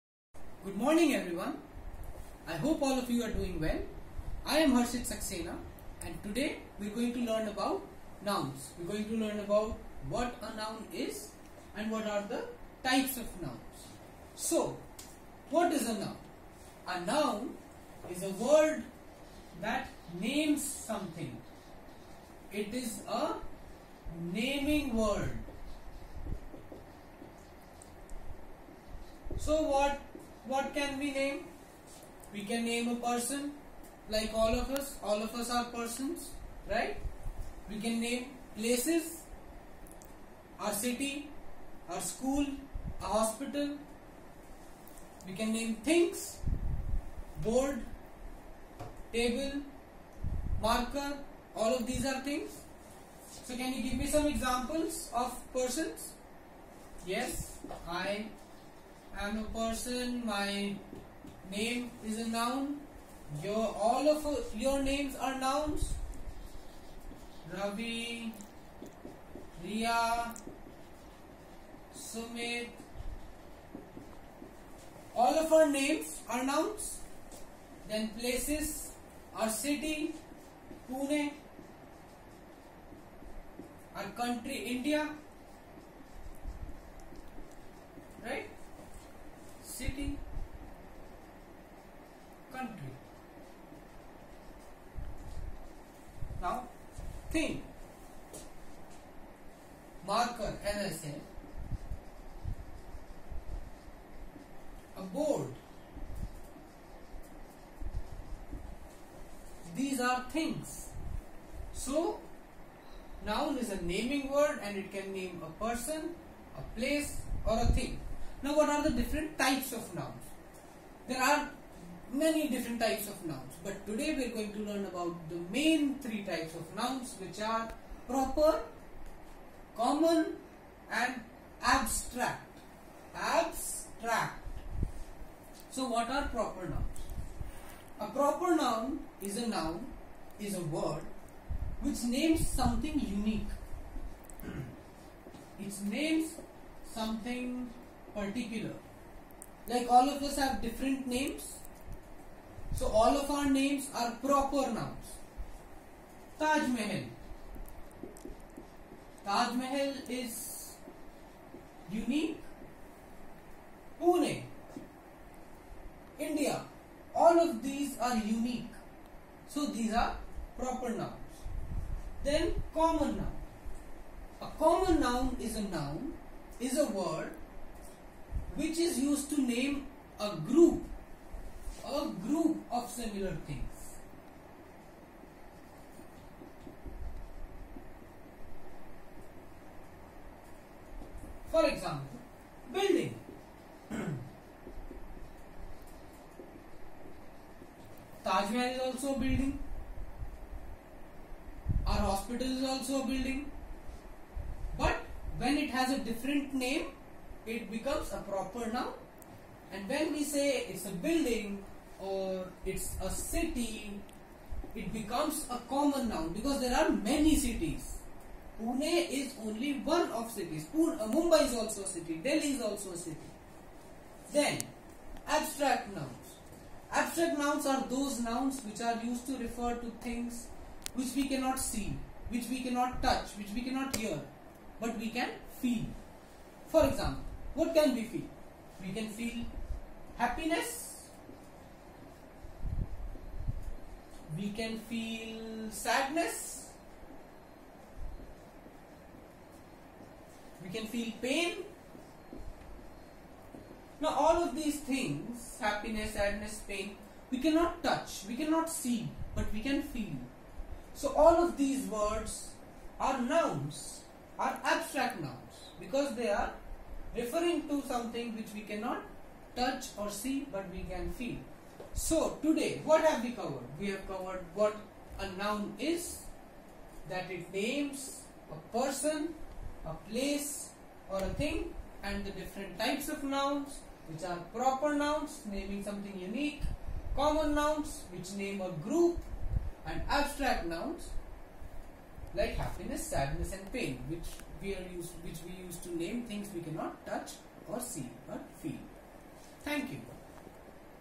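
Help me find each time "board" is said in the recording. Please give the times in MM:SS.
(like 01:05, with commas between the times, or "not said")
00:47, 01:45.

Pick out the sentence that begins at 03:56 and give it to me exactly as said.
For example, what can we feel?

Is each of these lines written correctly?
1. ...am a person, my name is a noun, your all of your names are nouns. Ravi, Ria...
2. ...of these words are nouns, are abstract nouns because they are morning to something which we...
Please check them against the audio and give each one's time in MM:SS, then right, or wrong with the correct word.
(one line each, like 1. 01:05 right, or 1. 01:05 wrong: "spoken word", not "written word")
1. 00:59 right
2. 04:21 wrong: "referring", not "morning".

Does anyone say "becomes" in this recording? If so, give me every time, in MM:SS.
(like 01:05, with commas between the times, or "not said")
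03:27, 03:34.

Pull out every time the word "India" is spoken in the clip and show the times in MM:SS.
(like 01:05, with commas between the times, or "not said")
01:24, 02:46.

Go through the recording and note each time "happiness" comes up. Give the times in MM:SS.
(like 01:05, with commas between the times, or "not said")
04:00, 04:15, 04:52.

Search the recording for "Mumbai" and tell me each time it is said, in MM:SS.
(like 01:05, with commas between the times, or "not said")
03:41.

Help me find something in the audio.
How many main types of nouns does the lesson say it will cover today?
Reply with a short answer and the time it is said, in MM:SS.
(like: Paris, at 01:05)
3, at 02:05.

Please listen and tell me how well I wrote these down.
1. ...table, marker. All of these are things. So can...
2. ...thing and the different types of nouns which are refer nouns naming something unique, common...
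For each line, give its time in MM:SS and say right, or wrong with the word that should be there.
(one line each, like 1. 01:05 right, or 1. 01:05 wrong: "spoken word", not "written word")
1. 00:49 right
2. 04:41 wrong: "proper", not "refer".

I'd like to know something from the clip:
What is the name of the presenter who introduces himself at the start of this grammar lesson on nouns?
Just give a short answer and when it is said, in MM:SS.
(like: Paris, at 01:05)
Harshit Saxena, at 00:04.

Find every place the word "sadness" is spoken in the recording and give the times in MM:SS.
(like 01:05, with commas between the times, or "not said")
04:05, 04:16, 04:53.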